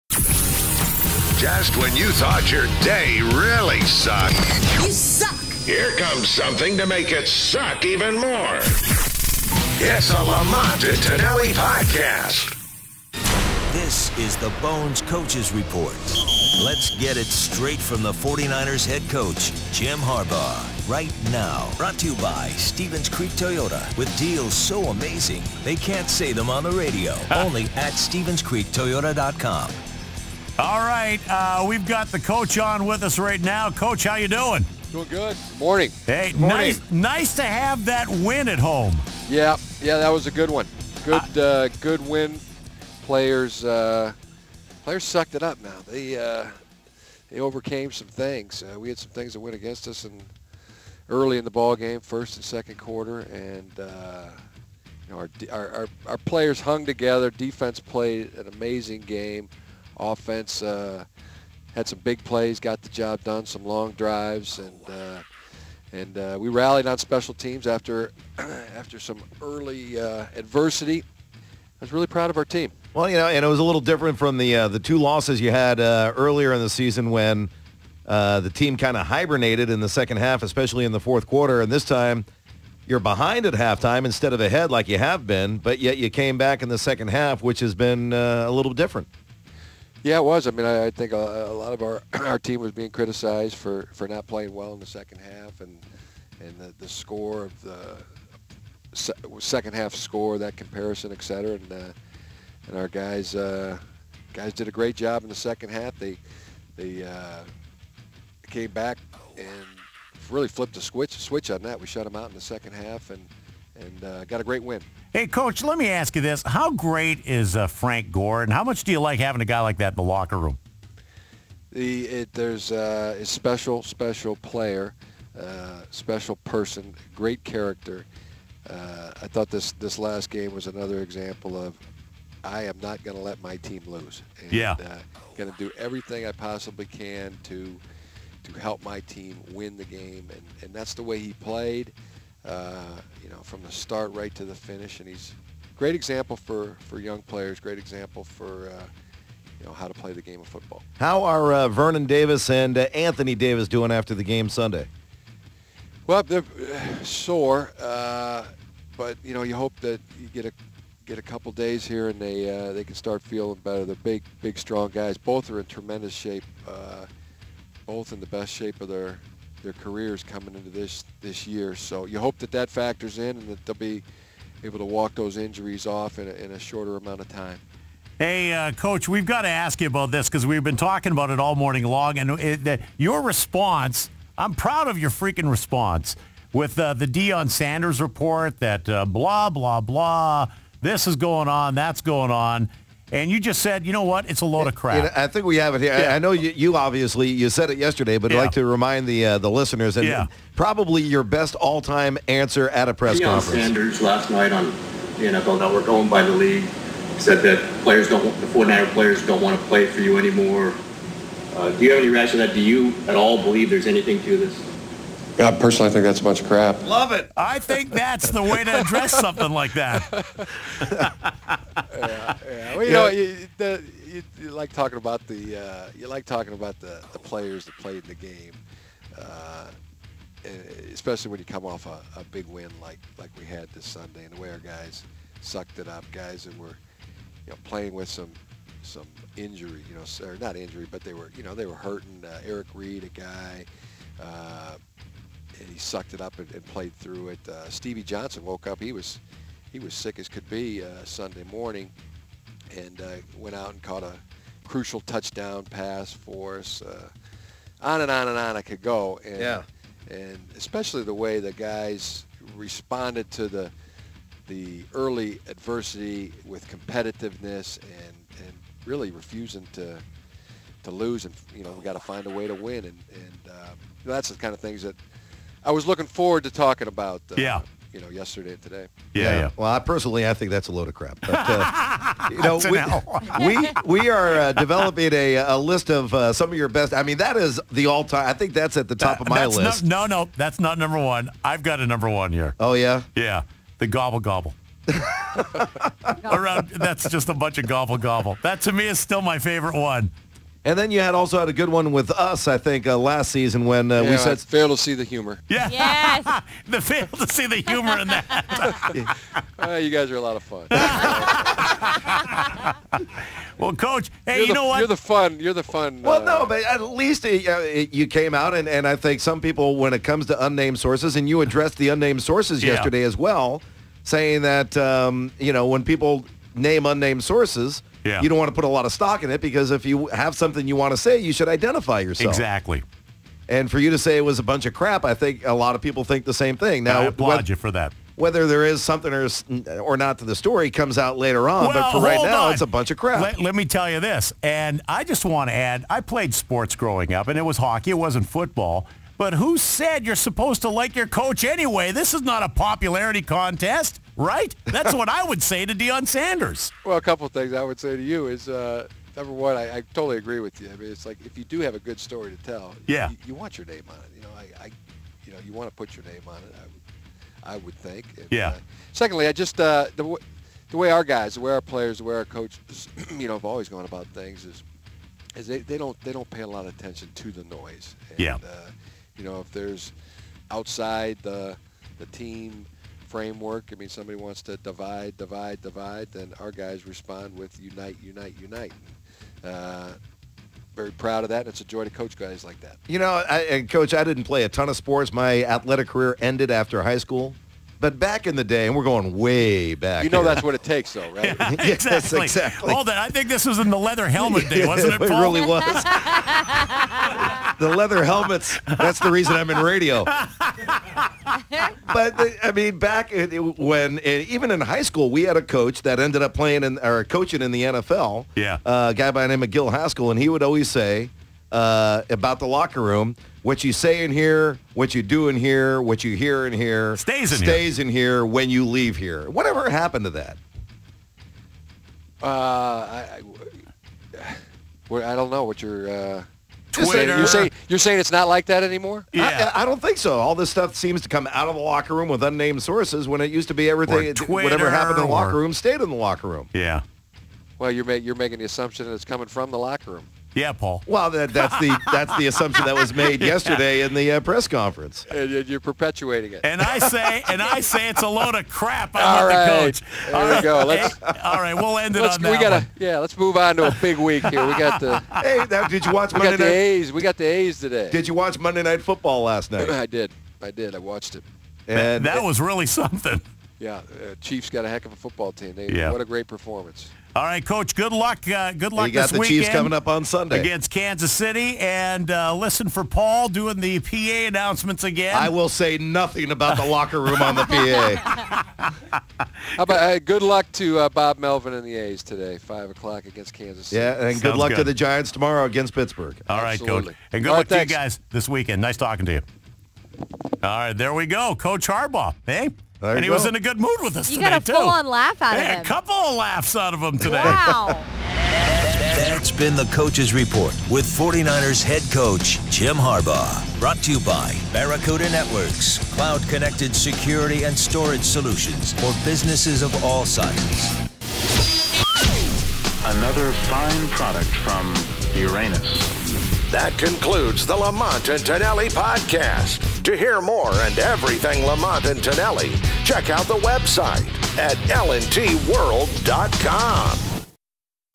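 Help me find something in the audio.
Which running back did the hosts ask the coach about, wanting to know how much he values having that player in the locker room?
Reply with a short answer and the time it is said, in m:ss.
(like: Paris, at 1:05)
Frank Gore, at 1:57.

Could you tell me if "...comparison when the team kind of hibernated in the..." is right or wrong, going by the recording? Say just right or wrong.
wrong.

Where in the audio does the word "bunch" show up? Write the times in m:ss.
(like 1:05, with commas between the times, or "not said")
3:36, 4:57, 5:34, 5:42.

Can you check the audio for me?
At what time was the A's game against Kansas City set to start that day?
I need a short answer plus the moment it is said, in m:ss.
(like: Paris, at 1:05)
5 o'clock, at 8:12.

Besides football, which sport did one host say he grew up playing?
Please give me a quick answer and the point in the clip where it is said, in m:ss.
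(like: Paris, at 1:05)
Hockey, at 5:47.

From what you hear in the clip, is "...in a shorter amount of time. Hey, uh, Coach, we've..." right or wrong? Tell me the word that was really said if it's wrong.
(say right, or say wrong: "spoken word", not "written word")
right.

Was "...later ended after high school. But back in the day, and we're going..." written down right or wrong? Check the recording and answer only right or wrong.
wrong.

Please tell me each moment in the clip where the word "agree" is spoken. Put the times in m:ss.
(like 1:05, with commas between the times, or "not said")
6:00.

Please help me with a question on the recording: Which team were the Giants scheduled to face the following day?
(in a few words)
Pittsburgh.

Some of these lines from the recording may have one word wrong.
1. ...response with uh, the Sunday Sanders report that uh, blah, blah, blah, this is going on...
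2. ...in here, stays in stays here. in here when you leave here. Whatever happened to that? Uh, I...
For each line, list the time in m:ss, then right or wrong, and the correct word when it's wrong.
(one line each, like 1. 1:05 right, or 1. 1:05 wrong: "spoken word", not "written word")
1. 3:05 wrong: "Deion", not "Sunday"
2. 7:06 right.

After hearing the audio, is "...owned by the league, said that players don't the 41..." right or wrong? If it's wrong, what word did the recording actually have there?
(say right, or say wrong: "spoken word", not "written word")
wrong: "49", not "41".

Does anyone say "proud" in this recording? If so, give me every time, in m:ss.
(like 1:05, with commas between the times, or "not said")
1:12, 3:04, 6:30.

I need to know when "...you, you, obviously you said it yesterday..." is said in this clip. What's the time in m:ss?
3:16.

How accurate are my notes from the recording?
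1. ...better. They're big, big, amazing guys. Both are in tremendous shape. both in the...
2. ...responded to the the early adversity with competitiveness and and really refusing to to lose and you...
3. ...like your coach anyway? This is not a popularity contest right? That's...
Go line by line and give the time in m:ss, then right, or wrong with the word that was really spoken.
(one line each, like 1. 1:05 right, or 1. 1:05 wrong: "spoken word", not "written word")
1. 2:43 wrong: "strong", not "amazing"
2. 4:22 right
3. 5:50 right.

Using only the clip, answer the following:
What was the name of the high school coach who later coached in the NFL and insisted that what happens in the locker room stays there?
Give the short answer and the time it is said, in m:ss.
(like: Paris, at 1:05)
Gil Haskell, at 6:59.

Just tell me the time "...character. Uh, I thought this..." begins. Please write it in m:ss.
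2:07.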